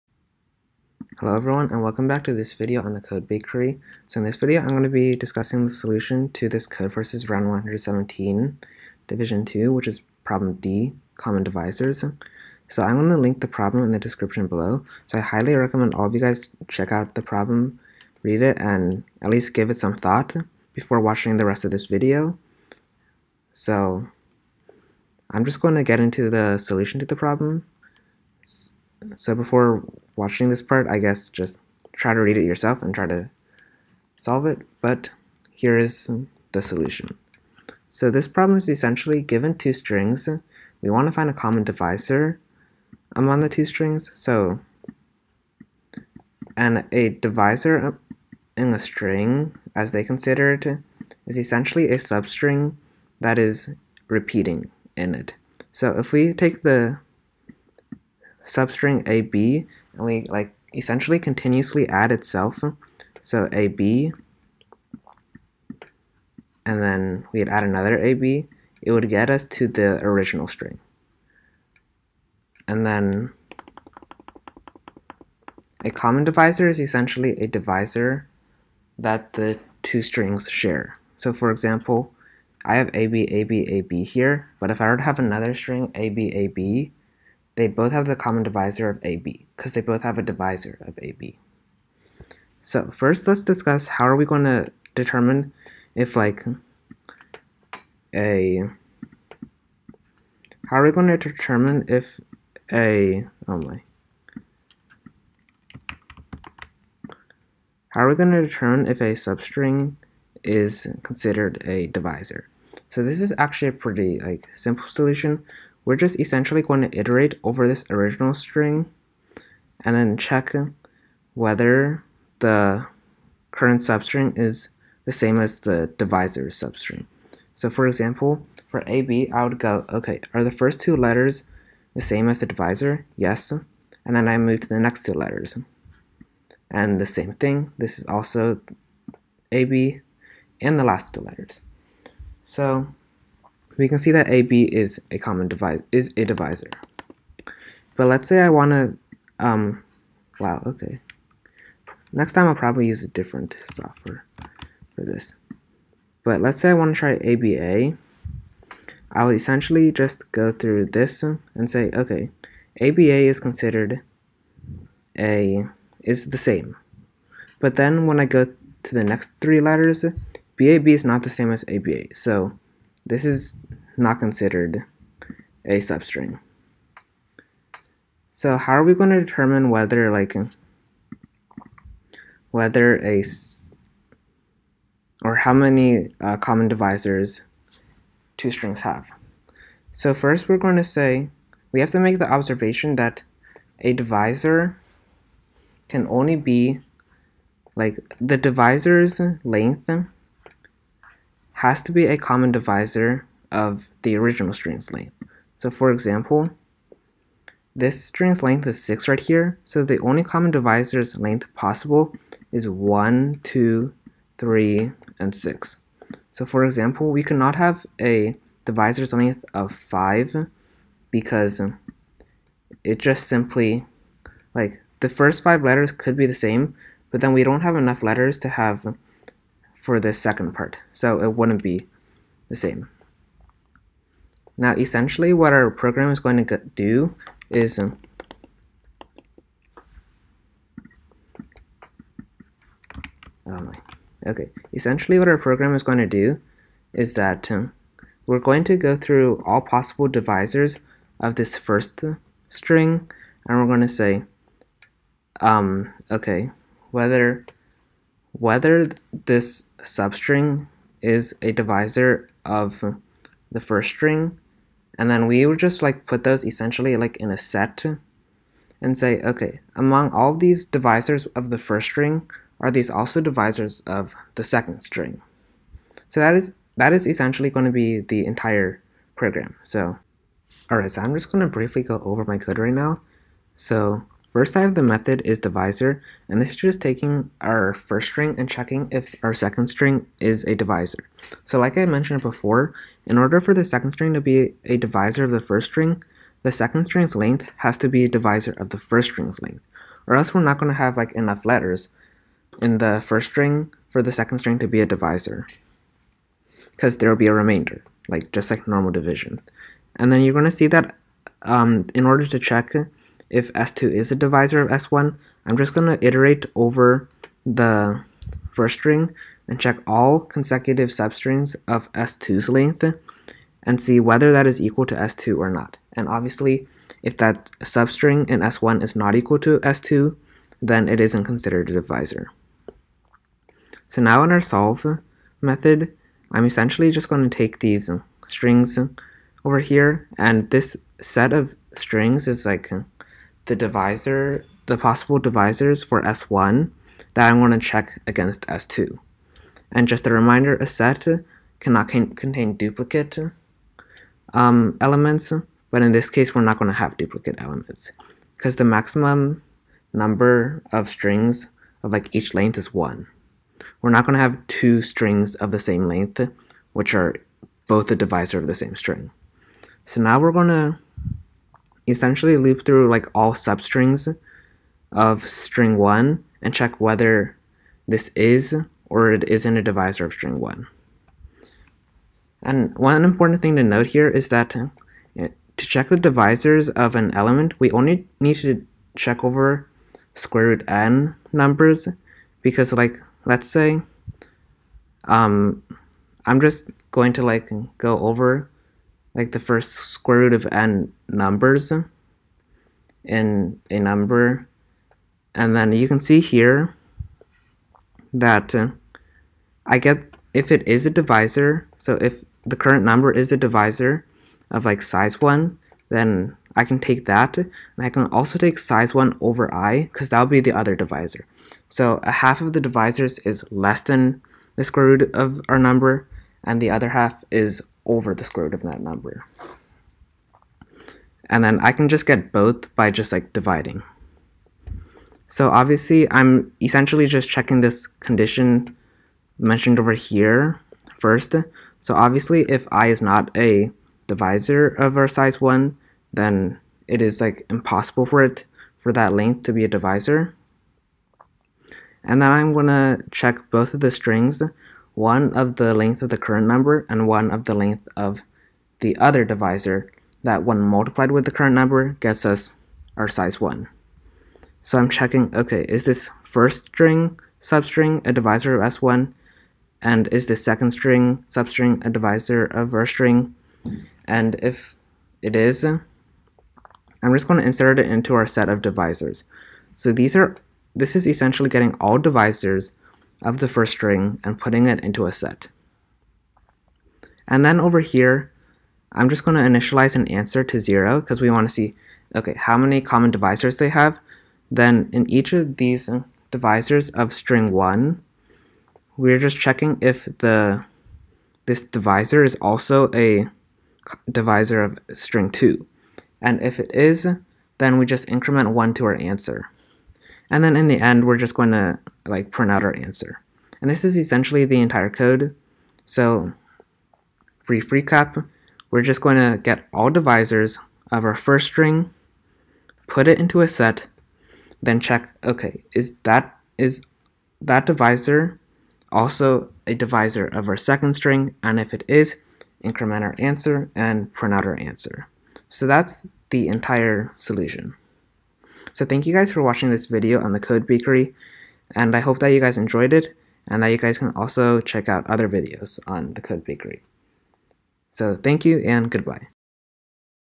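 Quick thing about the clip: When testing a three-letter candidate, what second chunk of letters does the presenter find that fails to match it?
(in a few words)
BAB.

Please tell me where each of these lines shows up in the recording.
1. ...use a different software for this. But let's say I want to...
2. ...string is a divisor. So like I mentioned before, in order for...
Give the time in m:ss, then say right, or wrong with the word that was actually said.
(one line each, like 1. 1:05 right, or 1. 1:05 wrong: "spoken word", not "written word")
1. 2:32 right
2. 4:49 right.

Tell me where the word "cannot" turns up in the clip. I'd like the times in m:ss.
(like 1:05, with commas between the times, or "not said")
3:37, 5:51.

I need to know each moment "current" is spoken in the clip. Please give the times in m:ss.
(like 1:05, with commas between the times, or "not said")
2:03, 6:52, 7:36, 7:41.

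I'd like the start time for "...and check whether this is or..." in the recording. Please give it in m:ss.
6:16.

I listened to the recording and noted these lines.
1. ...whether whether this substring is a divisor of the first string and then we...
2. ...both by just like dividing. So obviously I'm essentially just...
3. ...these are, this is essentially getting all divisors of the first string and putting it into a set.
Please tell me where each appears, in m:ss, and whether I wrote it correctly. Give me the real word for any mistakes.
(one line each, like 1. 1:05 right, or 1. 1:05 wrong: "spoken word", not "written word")
1. 4:16 right
2. 7:12 right
3. 7:59 right.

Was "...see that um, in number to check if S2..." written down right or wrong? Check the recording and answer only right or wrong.
wrong.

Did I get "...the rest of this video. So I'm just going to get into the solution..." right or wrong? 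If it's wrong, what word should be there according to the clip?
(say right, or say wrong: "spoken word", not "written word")
right.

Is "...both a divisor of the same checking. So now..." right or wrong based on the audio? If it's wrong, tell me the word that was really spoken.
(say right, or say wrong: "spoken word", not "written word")
wrong: "string", not "checking".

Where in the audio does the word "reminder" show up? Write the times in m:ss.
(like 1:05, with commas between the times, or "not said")
5:50.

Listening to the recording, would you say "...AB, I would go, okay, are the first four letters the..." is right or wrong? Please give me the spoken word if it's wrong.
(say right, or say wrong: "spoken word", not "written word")
wrong: "two", not "four".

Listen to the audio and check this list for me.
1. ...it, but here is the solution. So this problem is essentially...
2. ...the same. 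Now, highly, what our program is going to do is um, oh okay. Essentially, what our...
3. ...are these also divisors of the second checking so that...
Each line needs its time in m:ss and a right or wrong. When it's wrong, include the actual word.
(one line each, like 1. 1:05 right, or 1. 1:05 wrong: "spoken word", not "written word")
1. 0:34 right
2. 3:52 wrong: "essentially", not "highly"
3. 4:32 wrong: "string", not "checking".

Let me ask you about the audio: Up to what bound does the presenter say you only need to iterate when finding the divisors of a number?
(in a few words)
square root n.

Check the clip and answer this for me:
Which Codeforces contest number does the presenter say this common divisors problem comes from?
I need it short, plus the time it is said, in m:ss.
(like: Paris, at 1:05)
117, at 0:07.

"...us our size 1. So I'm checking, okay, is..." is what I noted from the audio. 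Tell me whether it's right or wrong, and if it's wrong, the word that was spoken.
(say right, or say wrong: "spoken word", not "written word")
right.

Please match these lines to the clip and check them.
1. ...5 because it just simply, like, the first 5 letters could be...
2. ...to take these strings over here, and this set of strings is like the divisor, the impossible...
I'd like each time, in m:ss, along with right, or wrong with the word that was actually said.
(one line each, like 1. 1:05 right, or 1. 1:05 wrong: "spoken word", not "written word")
1. 3:39 right
2. 5:37 wrong: "possible", not "impossible".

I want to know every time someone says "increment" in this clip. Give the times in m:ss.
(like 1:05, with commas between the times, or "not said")
8:28, 8:52.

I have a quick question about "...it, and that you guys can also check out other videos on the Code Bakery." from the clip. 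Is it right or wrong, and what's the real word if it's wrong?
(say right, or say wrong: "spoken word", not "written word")
right.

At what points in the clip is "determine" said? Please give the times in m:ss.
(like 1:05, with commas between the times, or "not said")
1:34, 1:41, 1:48, 2:59.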